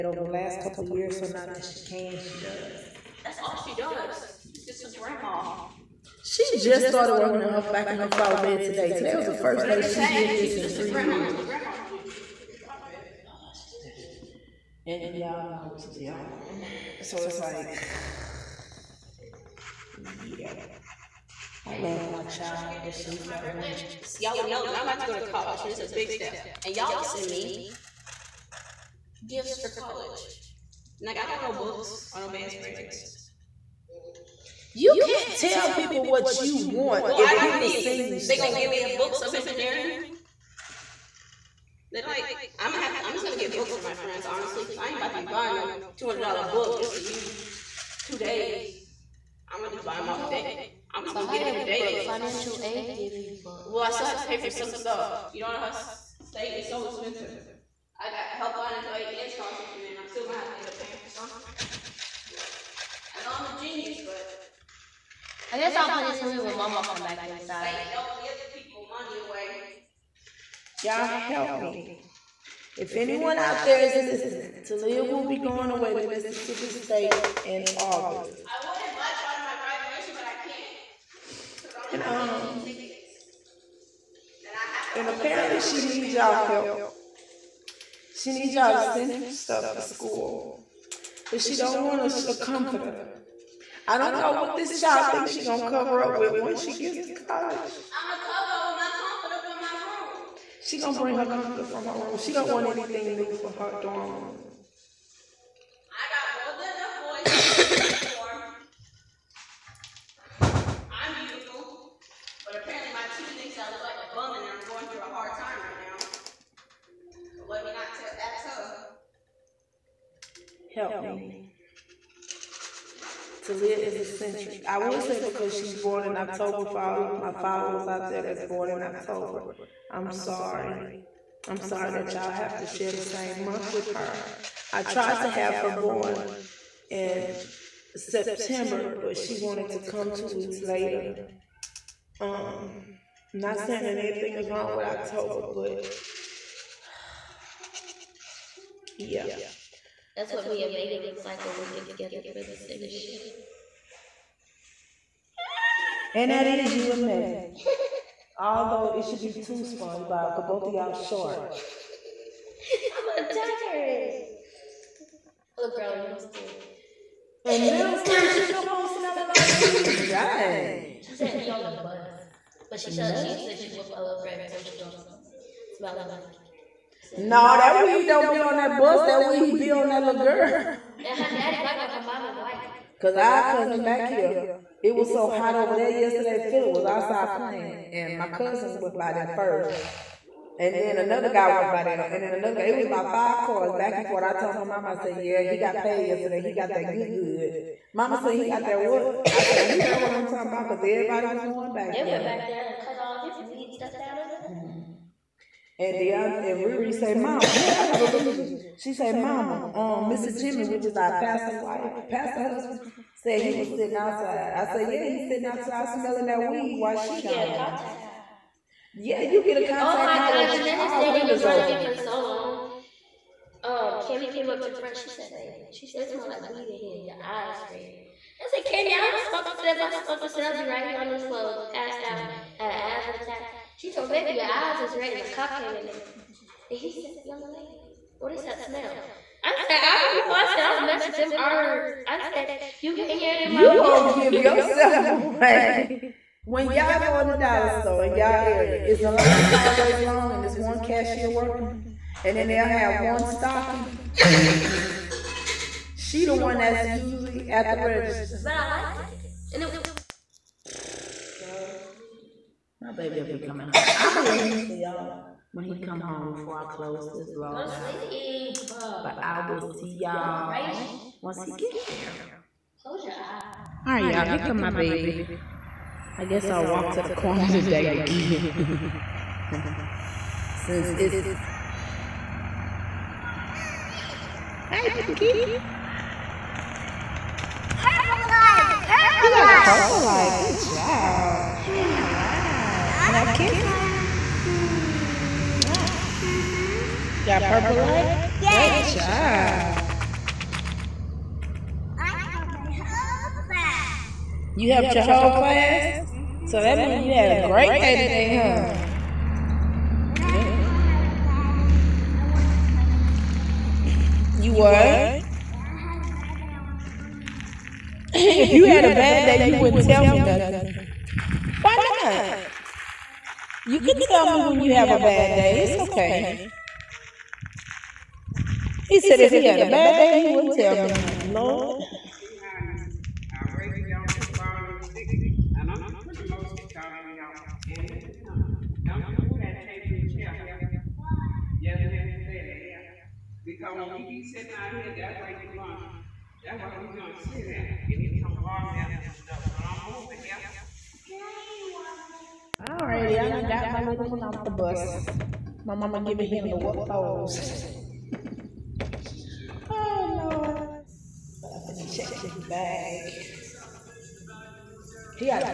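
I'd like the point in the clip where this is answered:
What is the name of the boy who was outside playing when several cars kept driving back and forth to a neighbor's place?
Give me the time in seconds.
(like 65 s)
186 s.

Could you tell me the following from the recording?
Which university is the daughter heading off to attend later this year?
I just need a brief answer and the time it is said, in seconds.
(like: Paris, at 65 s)
Mississippi State, at 76 s.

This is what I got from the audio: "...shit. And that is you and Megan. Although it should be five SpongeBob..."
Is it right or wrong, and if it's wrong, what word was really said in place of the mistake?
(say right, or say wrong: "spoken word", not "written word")
wrong: "two", not "five".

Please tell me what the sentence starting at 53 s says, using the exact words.
Well, I still have to pay for some stuff.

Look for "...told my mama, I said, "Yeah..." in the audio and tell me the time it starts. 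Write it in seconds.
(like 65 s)
194 s.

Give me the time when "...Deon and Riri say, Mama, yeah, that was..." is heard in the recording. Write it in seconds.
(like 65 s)
205 s.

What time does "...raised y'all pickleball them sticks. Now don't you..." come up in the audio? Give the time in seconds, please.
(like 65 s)
333 s.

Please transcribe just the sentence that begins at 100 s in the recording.
She gonna bring her comforter from her room.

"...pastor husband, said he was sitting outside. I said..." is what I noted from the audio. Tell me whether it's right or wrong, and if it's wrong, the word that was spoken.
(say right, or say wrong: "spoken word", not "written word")
right.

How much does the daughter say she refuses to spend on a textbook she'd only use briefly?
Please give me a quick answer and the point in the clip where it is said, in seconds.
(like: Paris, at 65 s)
$200, at 45 s.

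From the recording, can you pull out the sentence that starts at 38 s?
They are gonna give me a books of engineering.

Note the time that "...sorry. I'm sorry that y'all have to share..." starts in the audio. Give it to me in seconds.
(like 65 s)
130 s.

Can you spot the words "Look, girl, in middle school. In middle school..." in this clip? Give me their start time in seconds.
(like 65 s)
165 s.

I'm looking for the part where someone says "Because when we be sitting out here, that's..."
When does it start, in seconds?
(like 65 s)
343 s.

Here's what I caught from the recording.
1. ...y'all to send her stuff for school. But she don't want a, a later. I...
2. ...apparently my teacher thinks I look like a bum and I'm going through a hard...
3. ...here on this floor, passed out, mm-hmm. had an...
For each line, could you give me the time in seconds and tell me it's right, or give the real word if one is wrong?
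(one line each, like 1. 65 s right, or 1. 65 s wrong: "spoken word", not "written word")
1. 88 s wrong: "comforter", not "later"
2. 112 s right
3. 230 s right.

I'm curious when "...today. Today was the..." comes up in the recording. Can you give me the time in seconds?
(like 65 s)
8 s.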